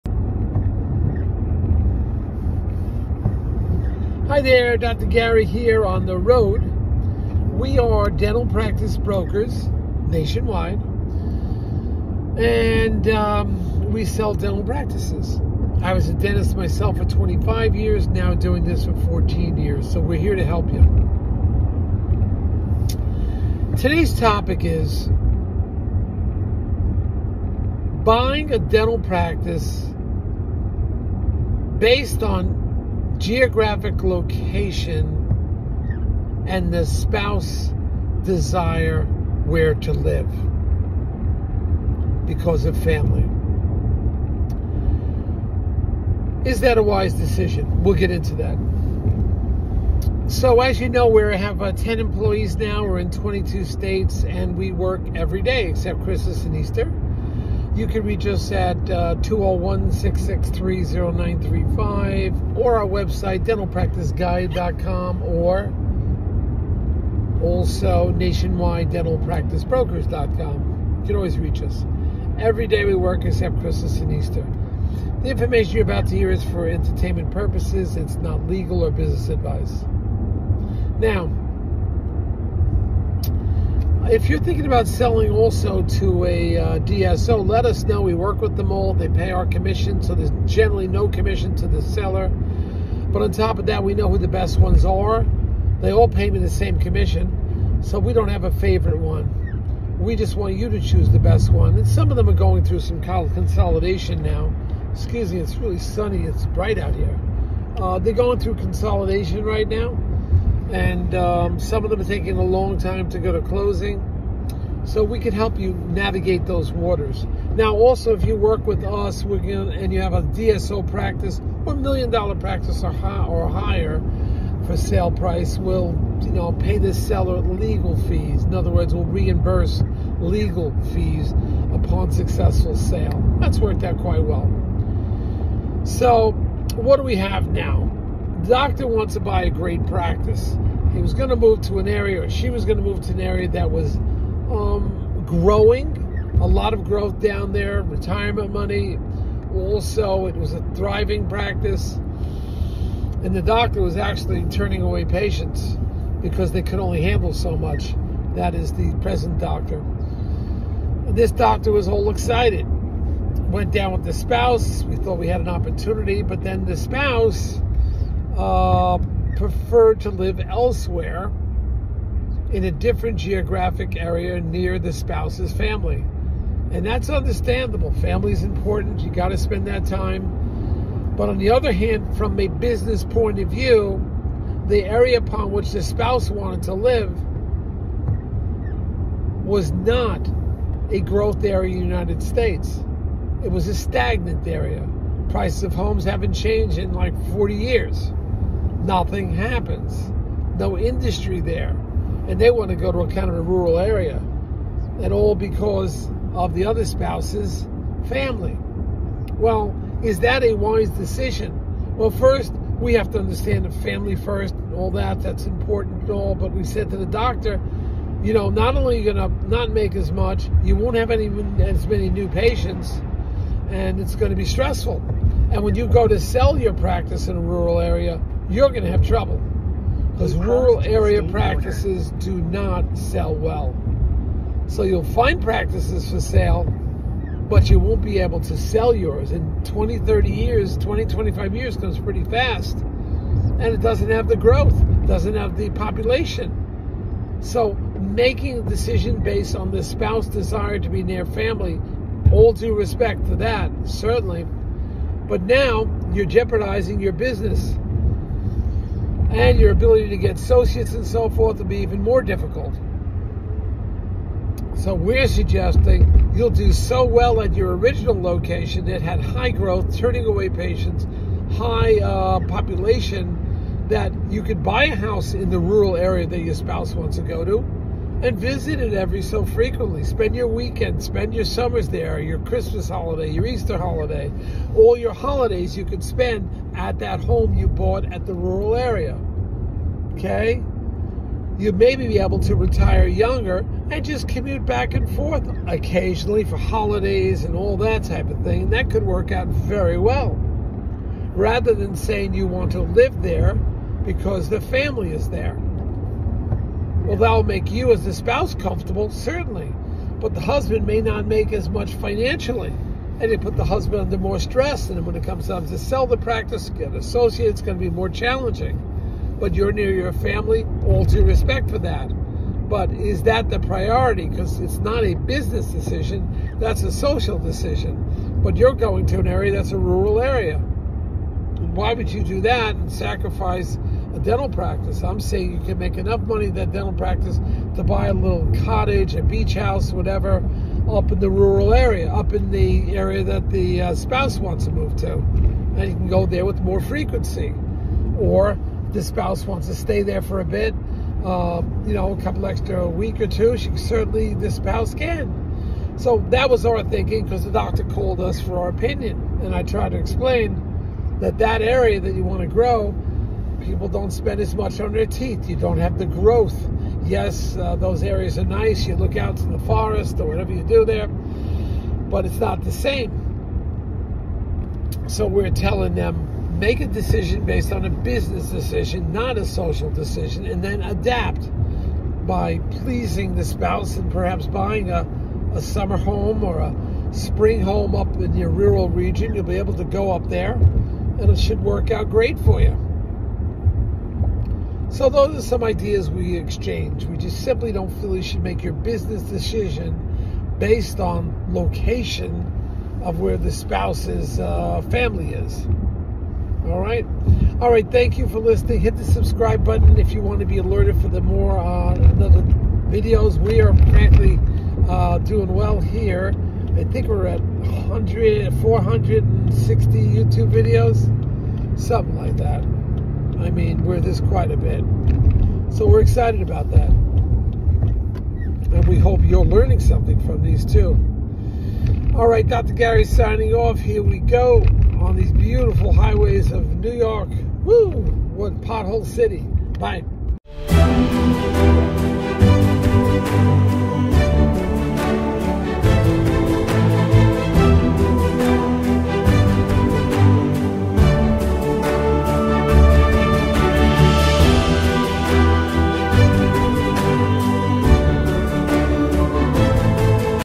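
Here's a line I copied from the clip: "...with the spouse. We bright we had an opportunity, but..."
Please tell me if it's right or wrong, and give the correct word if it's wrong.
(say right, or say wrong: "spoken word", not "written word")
wrong: "thought", not "bright".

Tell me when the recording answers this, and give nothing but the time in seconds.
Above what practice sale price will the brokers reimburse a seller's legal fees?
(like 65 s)
121 s.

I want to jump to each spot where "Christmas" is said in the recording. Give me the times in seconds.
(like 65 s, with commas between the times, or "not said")
56 s, 73 s, 282 s.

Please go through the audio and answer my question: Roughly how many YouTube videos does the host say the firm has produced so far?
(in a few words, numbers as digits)
460.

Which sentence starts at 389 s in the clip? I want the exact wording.
You'll be able to go up there and it should work out great for you.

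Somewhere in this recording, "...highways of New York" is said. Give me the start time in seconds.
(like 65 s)
435 s.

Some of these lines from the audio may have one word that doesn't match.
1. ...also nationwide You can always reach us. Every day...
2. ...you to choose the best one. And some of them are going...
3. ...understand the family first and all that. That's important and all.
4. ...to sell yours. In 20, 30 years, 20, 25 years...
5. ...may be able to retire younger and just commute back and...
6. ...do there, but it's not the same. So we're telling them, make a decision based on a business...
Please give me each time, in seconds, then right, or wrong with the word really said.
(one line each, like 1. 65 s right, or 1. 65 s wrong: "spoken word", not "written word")
1. 67 s right
2. 100 s right
3. 213 s right
4. 238 s right
5. 291 s right
6. 370 s right.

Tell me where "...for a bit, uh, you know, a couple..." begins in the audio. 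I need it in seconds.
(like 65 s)
350 s.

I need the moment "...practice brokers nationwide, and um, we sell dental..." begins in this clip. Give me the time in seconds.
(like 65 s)
8 s.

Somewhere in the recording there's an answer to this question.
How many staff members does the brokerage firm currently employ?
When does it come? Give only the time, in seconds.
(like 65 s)
51 s.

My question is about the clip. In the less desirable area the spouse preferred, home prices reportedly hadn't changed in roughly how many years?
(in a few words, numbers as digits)
40 years.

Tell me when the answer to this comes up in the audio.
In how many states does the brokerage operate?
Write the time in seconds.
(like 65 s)
53 s.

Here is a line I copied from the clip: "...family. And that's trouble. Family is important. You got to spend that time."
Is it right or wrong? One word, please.
wrong.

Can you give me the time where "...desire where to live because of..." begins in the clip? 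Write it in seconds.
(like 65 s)
38 s.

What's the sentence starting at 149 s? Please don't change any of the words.
Also, it was a thriving practice.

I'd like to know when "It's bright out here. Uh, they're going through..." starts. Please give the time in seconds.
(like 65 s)
106 s.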